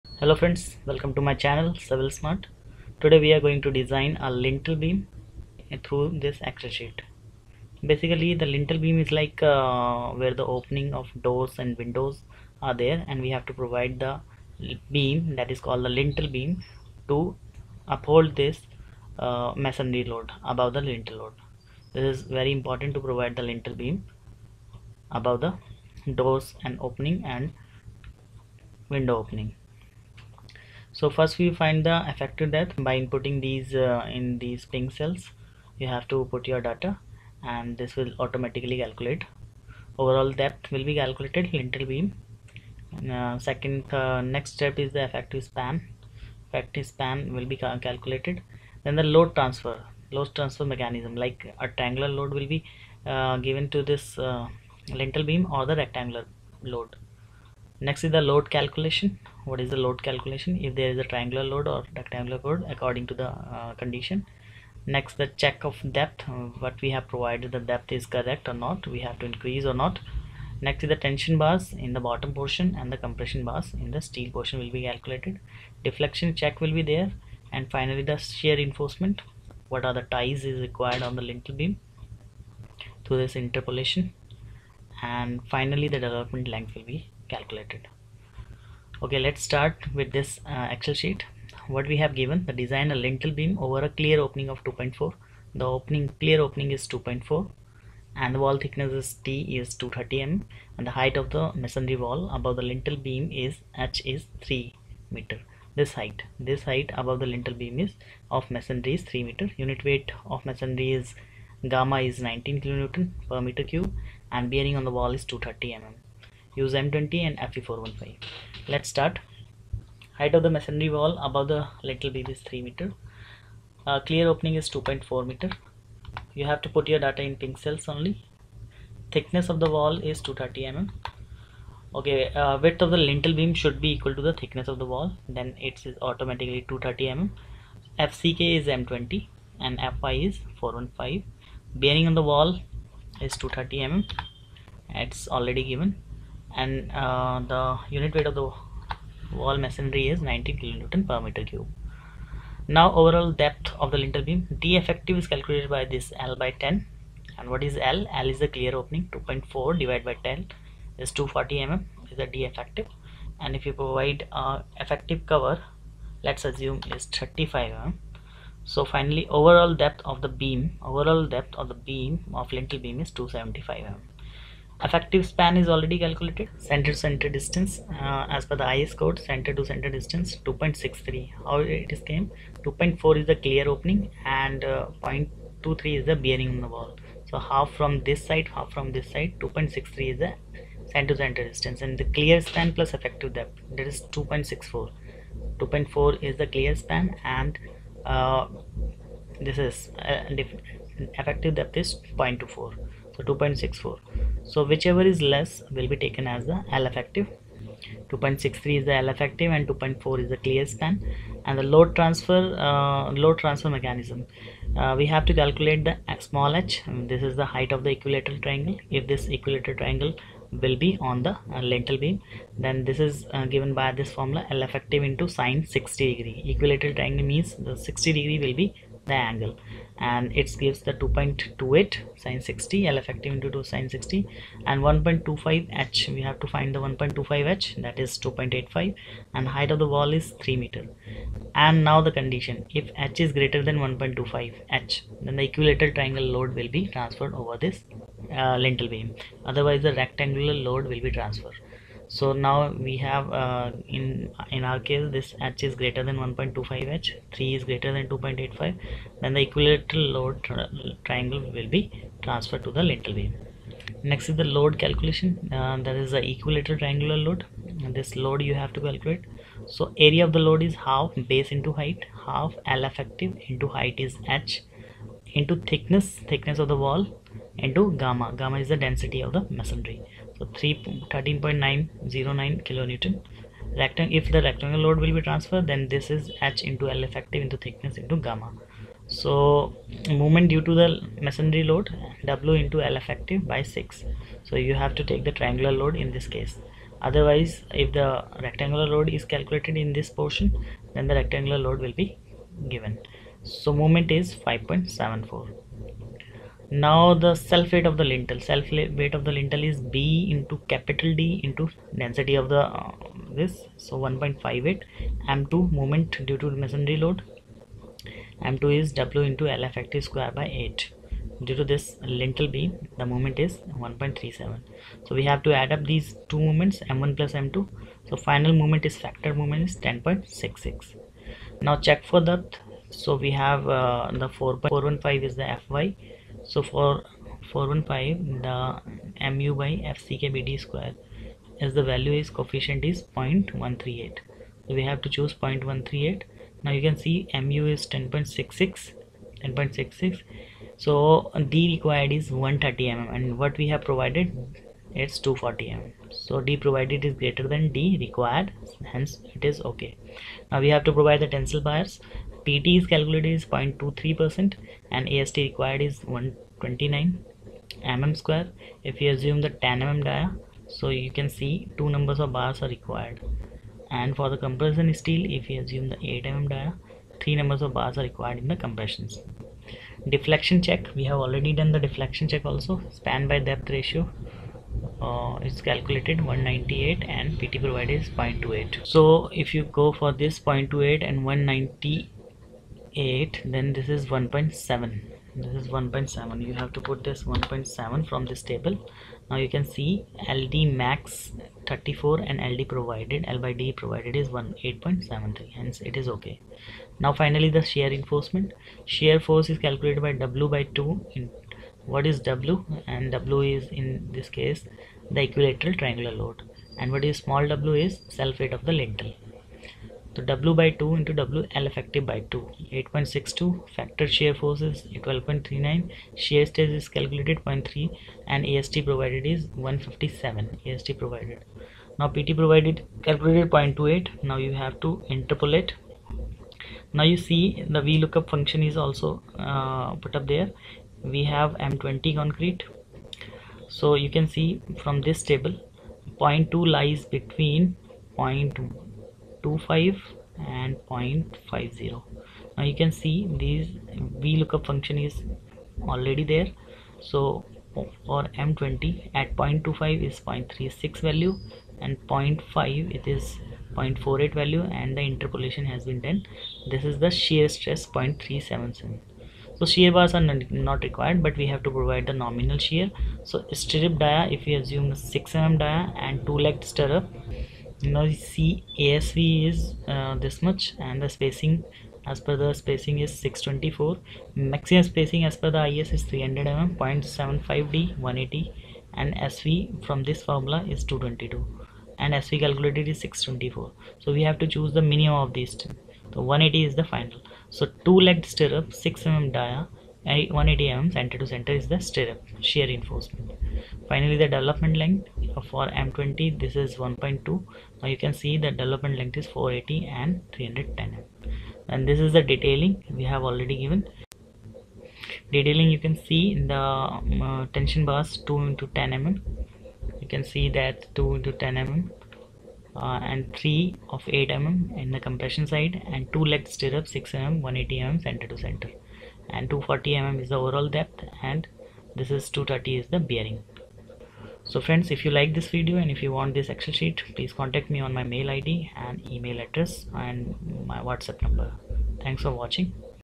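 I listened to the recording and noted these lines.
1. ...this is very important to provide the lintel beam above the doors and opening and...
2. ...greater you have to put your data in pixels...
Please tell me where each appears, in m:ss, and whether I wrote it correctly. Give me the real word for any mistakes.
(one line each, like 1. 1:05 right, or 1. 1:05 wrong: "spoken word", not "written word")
1. 0:21 right
2. 2:05 wrong: "meter", not "greater".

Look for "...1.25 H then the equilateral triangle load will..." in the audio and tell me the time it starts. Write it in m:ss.
4:03.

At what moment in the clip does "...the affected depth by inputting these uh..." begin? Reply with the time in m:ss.
0:31.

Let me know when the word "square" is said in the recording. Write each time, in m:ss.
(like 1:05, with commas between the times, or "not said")
5:20, 5:40, 6:08.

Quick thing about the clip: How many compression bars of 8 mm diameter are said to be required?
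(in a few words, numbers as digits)
3.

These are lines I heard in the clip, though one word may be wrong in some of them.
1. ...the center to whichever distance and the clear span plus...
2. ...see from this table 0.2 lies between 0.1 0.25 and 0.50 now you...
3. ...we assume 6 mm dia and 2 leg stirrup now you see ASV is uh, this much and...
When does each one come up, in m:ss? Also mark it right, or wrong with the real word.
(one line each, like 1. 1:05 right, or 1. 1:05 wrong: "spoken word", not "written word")
1. 3:10 wrong: "center", not "whichever"
2. 7:24 right
3. 7:54 right.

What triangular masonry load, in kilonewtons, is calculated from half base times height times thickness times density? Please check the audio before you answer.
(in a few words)
13.909.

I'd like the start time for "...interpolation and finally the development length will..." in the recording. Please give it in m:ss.
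1:23.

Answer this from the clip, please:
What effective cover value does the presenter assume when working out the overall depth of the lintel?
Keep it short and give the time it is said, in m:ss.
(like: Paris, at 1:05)
35 mm, at 2:47.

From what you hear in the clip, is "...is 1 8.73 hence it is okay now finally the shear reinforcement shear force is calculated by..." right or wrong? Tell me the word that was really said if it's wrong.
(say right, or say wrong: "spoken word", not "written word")
right.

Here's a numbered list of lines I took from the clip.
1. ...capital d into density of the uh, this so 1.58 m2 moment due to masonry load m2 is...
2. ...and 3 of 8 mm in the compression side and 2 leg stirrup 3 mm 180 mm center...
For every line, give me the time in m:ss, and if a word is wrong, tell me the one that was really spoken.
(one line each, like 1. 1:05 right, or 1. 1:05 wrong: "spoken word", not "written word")
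1. 5:10 right
2. 8:43 wrong: "6", not "3".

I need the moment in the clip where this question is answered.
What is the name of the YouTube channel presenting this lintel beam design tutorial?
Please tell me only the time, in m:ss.
0:01.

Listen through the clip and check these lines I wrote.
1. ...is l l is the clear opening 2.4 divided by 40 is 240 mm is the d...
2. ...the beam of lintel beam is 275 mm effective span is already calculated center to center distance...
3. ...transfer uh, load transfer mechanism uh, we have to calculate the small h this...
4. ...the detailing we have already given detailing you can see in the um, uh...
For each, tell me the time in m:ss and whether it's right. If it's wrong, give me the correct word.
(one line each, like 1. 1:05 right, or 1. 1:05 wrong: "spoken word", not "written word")
1. 2:37 wrong: "10", not "40"
2. 2:51 right
3. 3:31 right
4. 8:32 right.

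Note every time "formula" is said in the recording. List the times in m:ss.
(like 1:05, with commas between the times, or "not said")
3:44, 8:10.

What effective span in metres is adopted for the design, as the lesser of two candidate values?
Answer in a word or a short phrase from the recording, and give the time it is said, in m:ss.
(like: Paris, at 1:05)
2.63, at 3:28.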